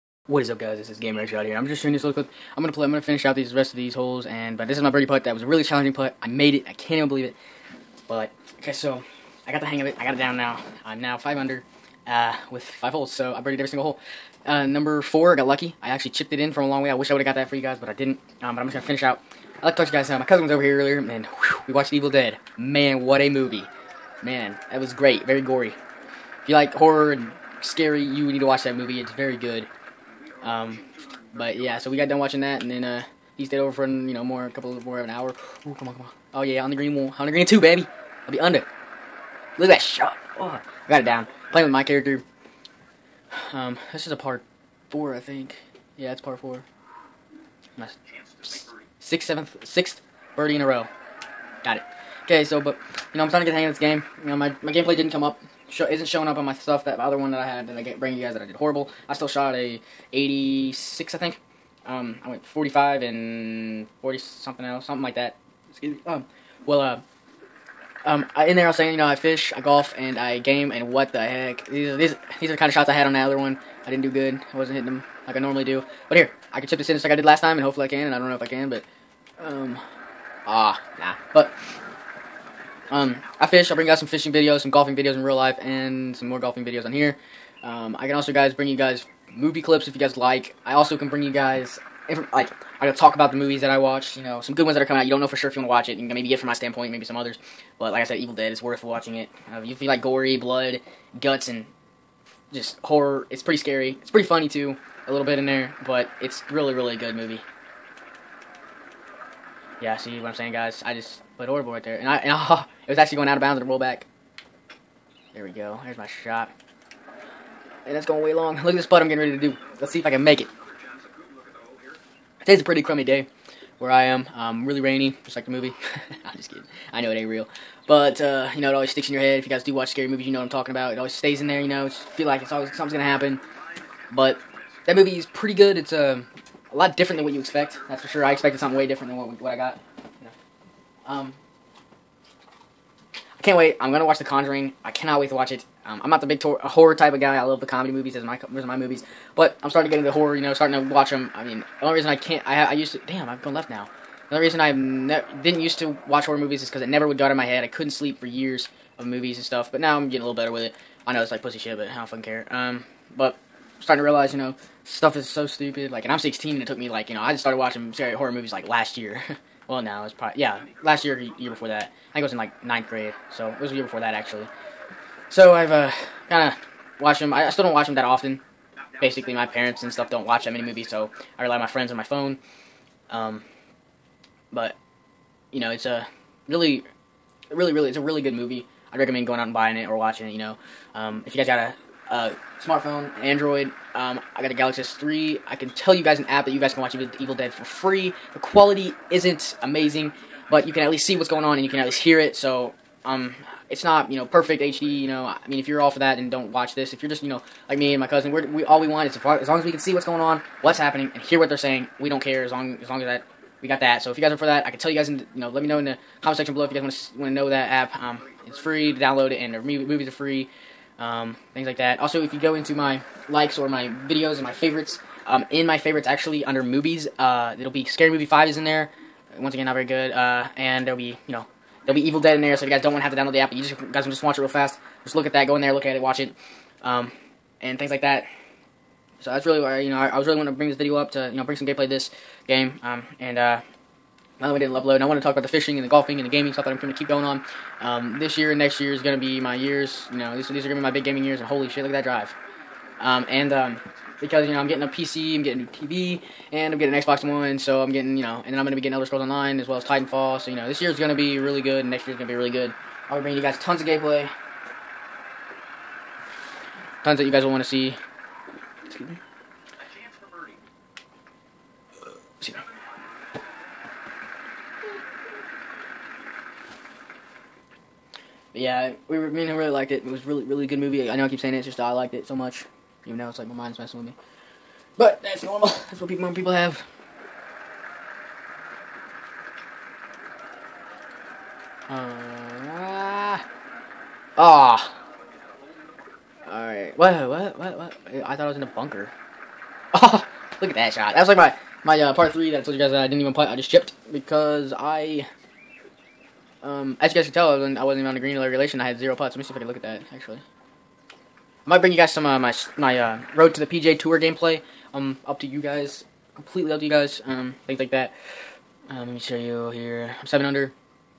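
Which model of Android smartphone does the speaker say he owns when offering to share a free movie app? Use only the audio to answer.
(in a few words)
Galaxy S3.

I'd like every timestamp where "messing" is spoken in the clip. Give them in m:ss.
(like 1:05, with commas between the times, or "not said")
4:43.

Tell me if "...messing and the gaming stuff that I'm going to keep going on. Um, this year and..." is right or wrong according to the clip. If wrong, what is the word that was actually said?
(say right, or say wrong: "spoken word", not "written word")
wrong: "golfing", not "messing".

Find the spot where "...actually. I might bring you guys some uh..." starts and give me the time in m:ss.
5:10.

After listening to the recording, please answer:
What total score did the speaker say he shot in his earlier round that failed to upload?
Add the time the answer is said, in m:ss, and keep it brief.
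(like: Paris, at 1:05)
86, at 1:00.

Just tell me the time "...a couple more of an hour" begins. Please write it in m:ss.
0:34.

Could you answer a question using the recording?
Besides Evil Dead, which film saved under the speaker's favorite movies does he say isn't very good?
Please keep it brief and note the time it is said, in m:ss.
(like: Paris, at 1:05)
Scary Movie 5, at 3:47.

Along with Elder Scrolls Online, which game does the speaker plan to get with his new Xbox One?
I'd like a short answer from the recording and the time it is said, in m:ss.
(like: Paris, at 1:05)
Titanfall, at 4:19.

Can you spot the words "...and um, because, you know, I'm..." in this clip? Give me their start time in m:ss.
4:13.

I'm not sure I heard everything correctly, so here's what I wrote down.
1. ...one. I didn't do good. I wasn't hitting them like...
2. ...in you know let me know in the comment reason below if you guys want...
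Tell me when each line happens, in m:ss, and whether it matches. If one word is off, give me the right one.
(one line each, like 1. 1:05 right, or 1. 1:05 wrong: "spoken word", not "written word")
1. 1:13 right
2. 3:35 wrong: "section", not "reason".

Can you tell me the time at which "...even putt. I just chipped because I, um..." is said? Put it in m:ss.
5:03.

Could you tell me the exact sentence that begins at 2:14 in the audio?
But that movie is pretty good.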